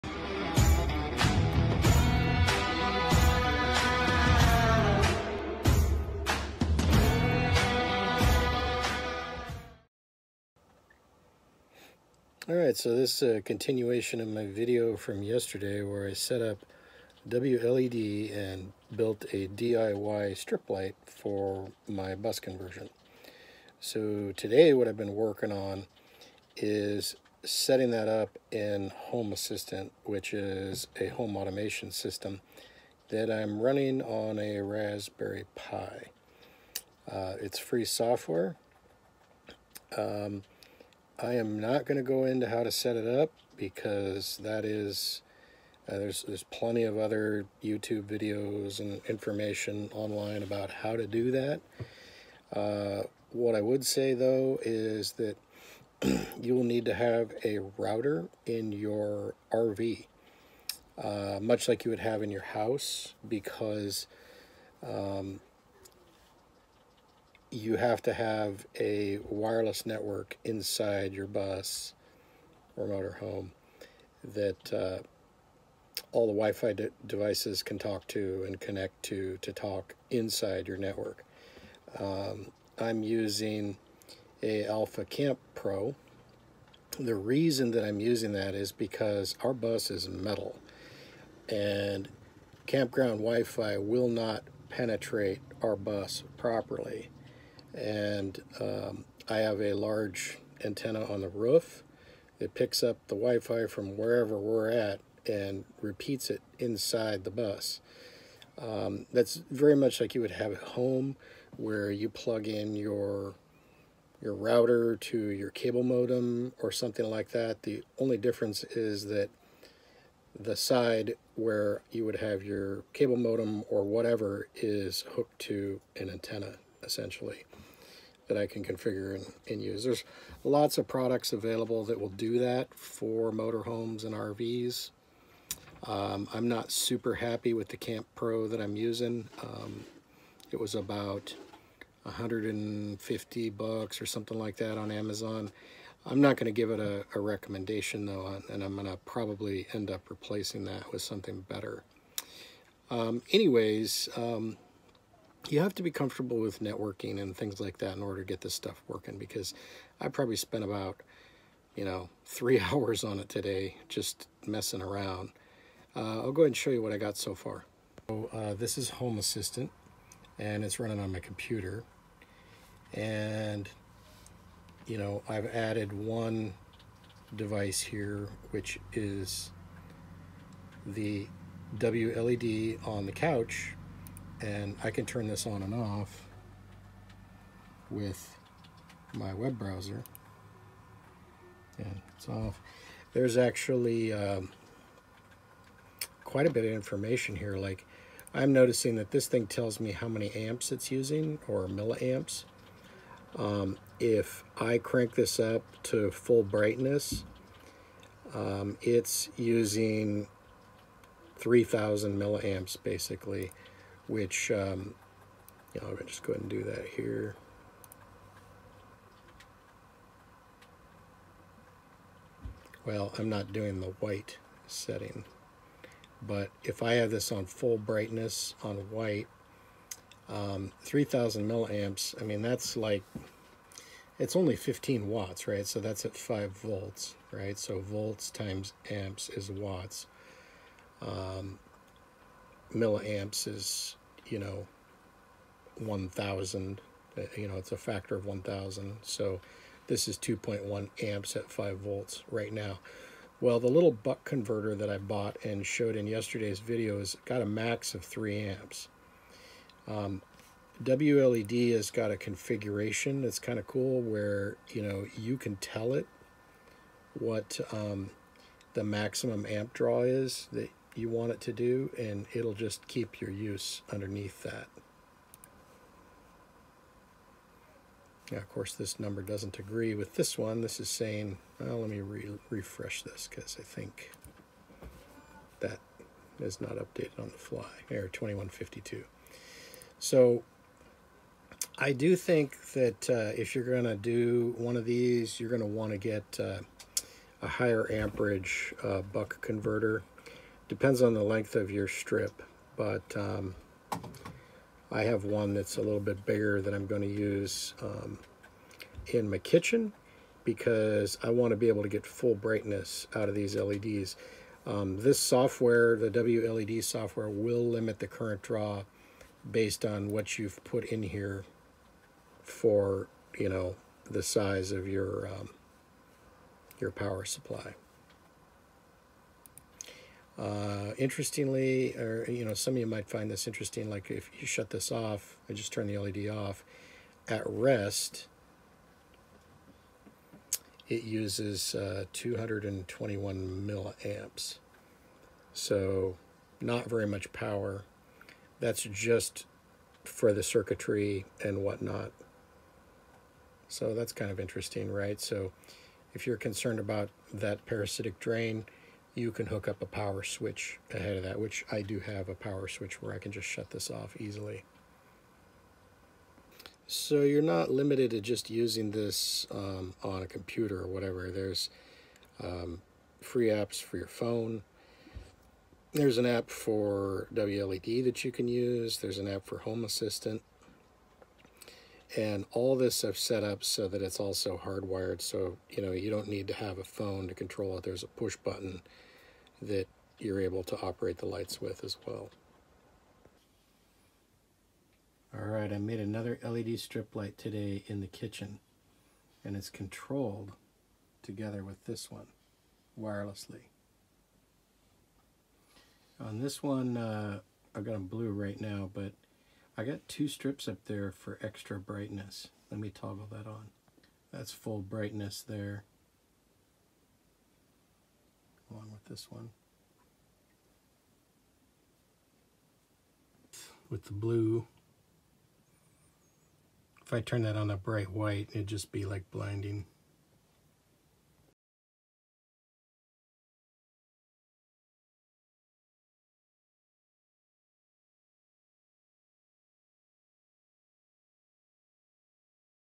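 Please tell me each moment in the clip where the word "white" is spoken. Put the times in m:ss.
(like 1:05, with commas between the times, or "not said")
3:44, 3:48, 7:08.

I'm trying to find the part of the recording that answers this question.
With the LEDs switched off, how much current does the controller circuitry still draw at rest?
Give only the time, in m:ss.
5:42.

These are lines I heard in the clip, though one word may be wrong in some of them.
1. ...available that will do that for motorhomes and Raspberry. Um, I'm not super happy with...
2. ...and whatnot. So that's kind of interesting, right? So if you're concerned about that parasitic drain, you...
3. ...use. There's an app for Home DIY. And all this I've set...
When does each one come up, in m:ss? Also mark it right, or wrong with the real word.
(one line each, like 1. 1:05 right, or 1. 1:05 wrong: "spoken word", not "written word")
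1. 2:11 wrong: "RVs", not "Raspberry"
2. 5:51 right
3. 6:18 wrong: "Assistant", not "DIY".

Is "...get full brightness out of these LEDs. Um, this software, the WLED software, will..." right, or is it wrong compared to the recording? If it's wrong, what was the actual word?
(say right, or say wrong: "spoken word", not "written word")
right.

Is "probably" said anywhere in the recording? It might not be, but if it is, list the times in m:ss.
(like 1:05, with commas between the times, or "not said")
2:29, 2:40.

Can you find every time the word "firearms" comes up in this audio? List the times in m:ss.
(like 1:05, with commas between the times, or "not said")
not said.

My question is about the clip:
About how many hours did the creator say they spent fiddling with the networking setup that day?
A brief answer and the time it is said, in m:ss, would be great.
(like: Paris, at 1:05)
3 hours, at 2:42.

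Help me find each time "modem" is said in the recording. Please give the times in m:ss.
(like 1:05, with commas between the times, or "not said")
1:55, 2:03.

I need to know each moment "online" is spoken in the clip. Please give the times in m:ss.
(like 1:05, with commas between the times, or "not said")
0:49.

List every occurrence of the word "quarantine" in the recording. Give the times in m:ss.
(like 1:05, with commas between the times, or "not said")
not said.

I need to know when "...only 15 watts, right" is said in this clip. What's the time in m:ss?
3:54.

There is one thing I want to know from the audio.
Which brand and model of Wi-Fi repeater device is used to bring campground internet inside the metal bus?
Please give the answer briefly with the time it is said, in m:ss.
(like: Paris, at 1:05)
Alfa Camp Pro, at 1:24.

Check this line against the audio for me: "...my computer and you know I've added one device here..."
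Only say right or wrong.
right.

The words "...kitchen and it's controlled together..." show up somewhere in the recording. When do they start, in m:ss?
6:38.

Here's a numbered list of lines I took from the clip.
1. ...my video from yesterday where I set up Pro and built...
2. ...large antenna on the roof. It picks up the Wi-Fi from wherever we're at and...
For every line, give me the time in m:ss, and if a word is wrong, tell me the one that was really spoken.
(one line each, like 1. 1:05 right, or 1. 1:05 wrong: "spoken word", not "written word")
1. 0:14 wrong: "WLED", not "Pro"
2. 1:39 right.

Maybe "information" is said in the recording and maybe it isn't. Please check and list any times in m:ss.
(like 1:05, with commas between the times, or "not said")
0:49, 3:16.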